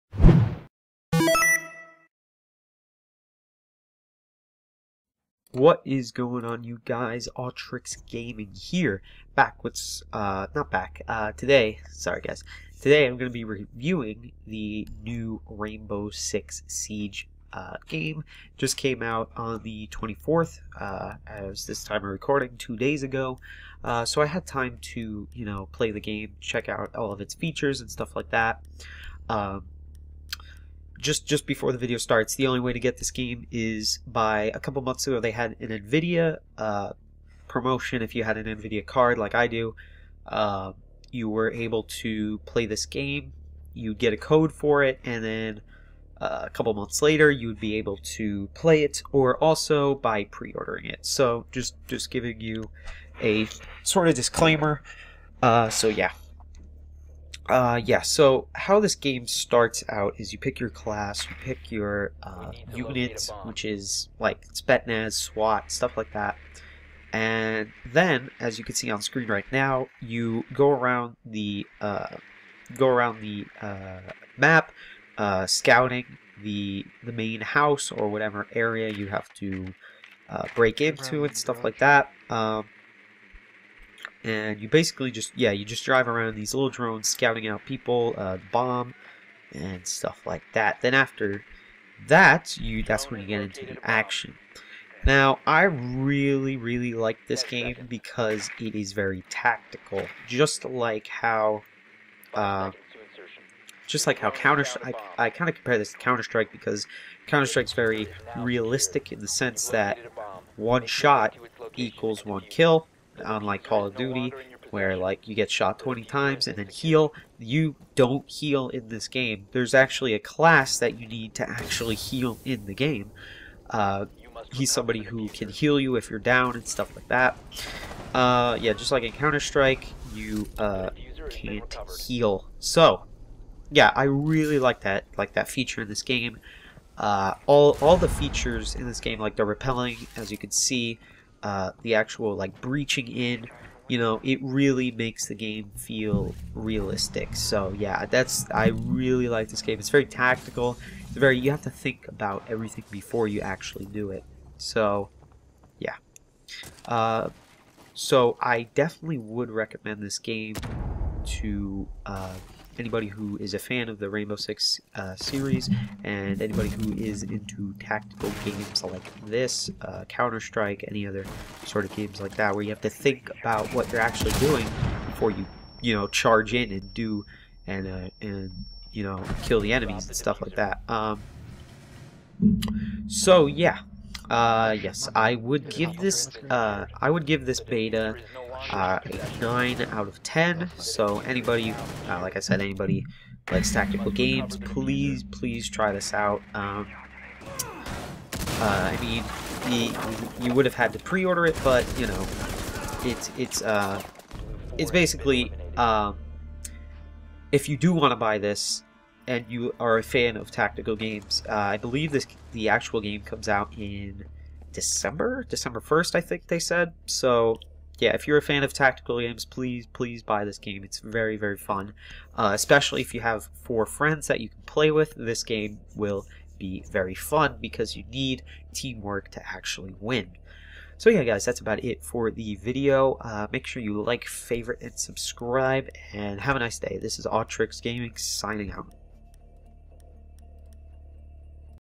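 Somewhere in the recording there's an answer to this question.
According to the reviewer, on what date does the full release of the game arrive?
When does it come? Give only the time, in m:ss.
3:35.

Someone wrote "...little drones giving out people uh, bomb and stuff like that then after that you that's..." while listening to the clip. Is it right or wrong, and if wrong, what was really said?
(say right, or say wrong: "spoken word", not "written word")
wrong: "scouting", not "giving".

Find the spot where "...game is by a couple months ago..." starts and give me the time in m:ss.
0:33.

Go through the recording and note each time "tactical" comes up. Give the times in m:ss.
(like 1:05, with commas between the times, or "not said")
1:39, 2:30, 2:47, 3:13, 3:30, 3:38.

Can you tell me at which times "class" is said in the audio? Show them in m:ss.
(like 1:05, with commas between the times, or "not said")
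1:00, 2:00.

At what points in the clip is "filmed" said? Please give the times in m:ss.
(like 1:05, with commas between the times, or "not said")
not said.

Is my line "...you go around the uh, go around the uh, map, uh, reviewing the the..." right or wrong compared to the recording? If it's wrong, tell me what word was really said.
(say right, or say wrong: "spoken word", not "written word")
wrong: "scouting", not "reviewing".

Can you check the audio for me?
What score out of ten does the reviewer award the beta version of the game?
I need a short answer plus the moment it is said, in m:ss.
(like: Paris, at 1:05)
9 out of 10, at 3:09.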